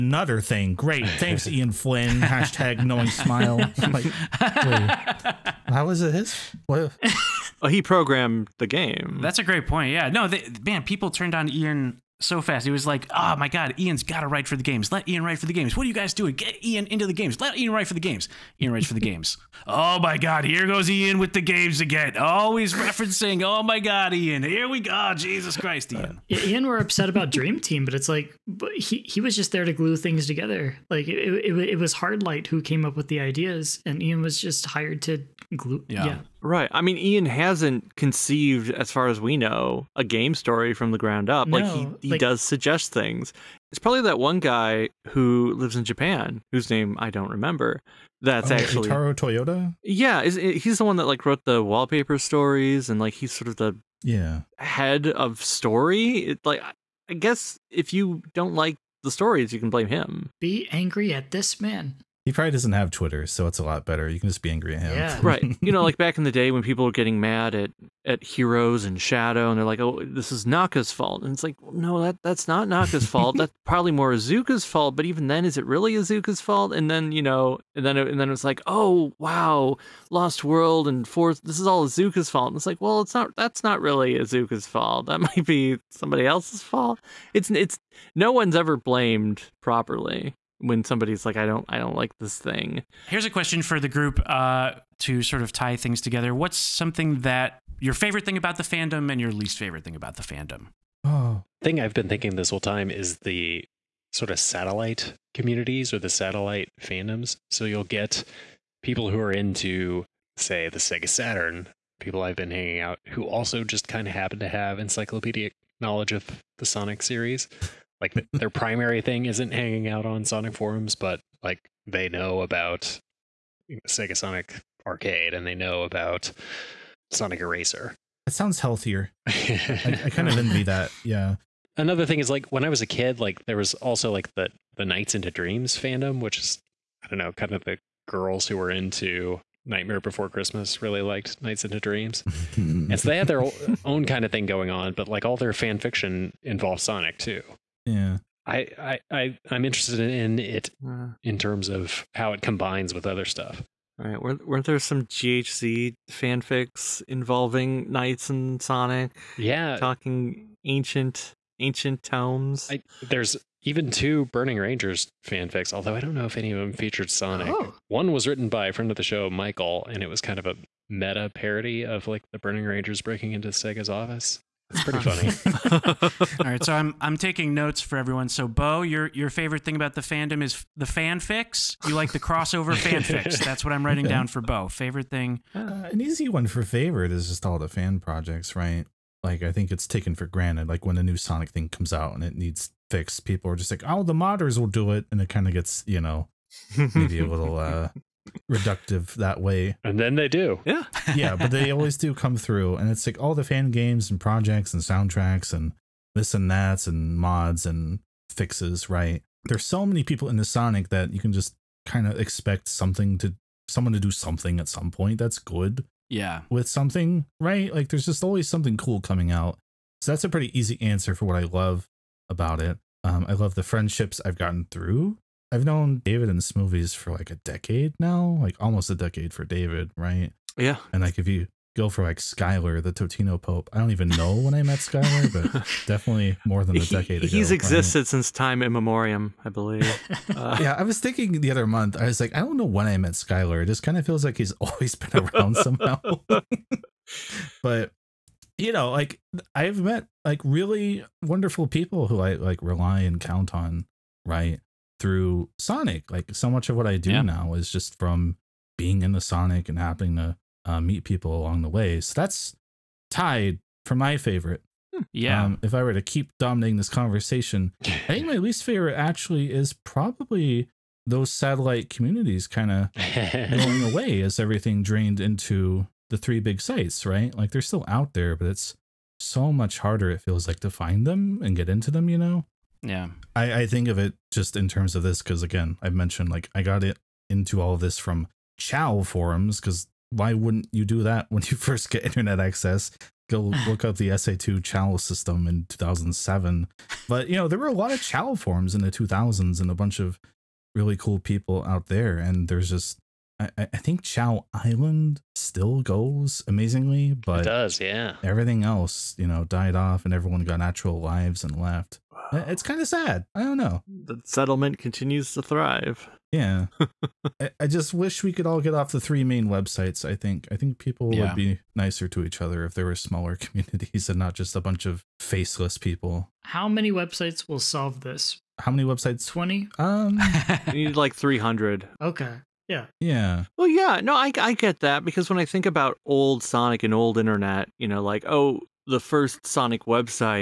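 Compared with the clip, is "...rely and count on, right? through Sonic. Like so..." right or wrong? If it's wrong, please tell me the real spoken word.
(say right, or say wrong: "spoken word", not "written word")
right.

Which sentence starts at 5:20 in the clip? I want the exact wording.
I think I think people yeah.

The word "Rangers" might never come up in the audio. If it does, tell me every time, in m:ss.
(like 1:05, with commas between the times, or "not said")
2:44, 2:52.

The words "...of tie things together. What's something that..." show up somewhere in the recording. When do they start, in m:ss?
1:35.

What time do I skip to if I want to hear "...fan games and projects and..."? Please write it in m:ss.
3:23.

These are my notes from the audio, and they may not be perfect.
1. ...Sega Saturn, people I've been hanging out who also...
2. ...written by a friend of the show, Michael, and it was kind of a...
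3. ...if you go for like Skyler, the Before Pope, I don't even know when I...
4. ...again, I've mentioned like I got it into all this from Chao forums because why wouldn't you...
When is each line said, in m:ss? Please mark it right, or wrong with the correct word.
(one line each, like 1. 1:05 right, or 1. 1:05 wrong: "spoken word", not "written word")
1. 1:50 right
2. 2:48 right
3. 3:51 wrong: "Totino", not "Before"
4. 4:45 right.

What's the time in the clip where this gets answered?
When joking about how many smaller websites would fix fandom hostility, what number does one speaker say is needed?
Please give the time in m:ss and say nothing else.
5:31.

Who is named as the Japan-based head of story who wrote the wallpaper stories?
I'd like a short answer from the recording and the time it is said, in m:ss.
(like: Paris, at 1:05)
Taro Toyoda, at 0:48.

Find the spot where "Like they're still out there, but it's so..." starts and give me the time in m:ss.
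4:37.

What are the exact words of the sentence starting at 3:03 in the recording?
That's what I'm writing down for Bo.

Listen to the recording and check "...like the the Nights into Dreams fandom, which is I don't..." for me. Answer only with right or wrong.
right.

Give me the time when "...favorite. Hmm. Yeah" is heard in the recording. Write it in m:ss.
4:24.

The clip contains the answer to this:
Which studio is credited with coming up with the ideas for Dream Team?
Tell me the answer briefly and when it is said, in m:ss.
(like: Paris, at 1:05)
Hardlight, at 0:31.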